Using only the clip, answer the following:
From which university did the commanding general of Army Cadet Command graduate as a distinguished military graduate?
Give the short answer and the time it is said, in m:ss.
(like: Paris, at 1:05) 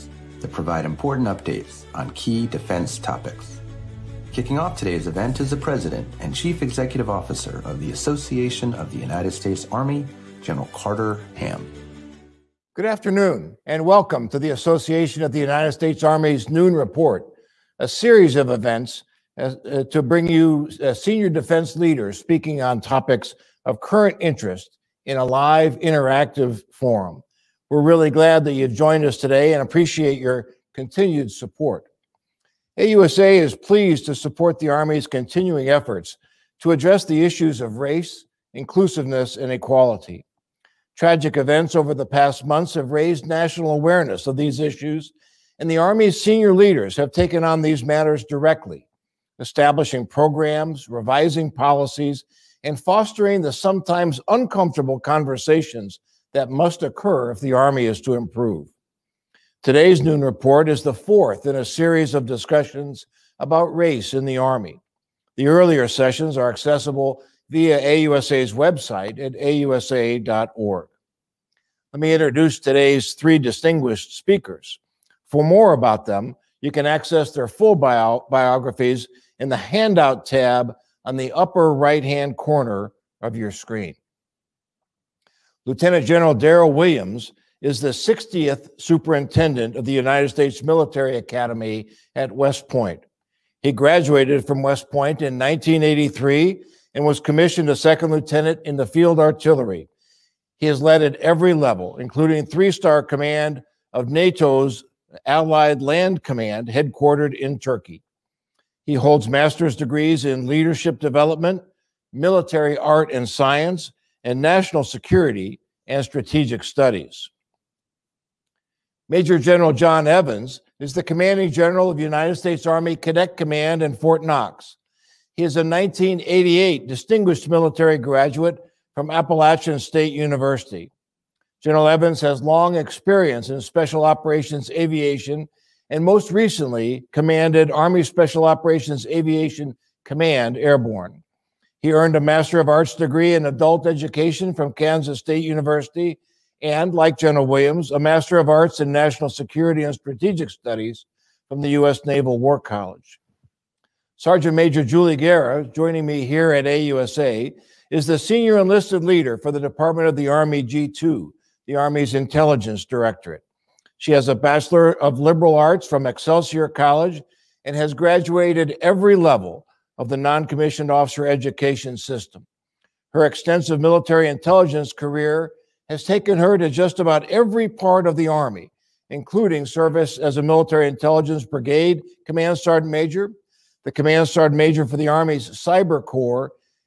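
Appalachian State University, at 2:09.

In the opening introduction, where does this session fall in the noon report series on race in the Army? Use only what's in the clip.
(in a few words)
fourth.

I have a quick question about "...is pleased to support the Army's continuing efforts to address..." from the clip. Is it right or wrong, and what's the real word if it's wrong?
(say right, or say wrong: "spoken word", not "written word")
right.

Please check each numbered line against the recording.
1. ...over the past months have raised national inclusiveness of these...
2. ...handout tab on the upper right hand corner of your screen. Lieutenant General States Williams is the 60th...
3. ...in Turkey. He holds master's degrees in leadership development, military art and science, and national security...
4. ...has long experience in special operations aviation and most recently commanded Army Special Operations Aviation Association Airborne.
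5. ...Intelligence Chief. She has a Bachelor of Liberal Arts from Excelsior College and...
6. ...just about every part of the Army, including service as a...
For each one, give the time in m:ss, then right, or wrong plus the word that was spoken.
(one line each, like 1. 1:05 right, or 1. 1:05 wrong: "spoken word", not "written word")
1. 0:41 wrong: "awareness", not "inclusiveness"
2. 1:19 wrong: "Darryl", not "States"
3. 1:47 right
4. 2:12 wrong: "Command", not "Association"
5. 2:42 wrong: "Directorate", not "Chief"
6. 2:56 right.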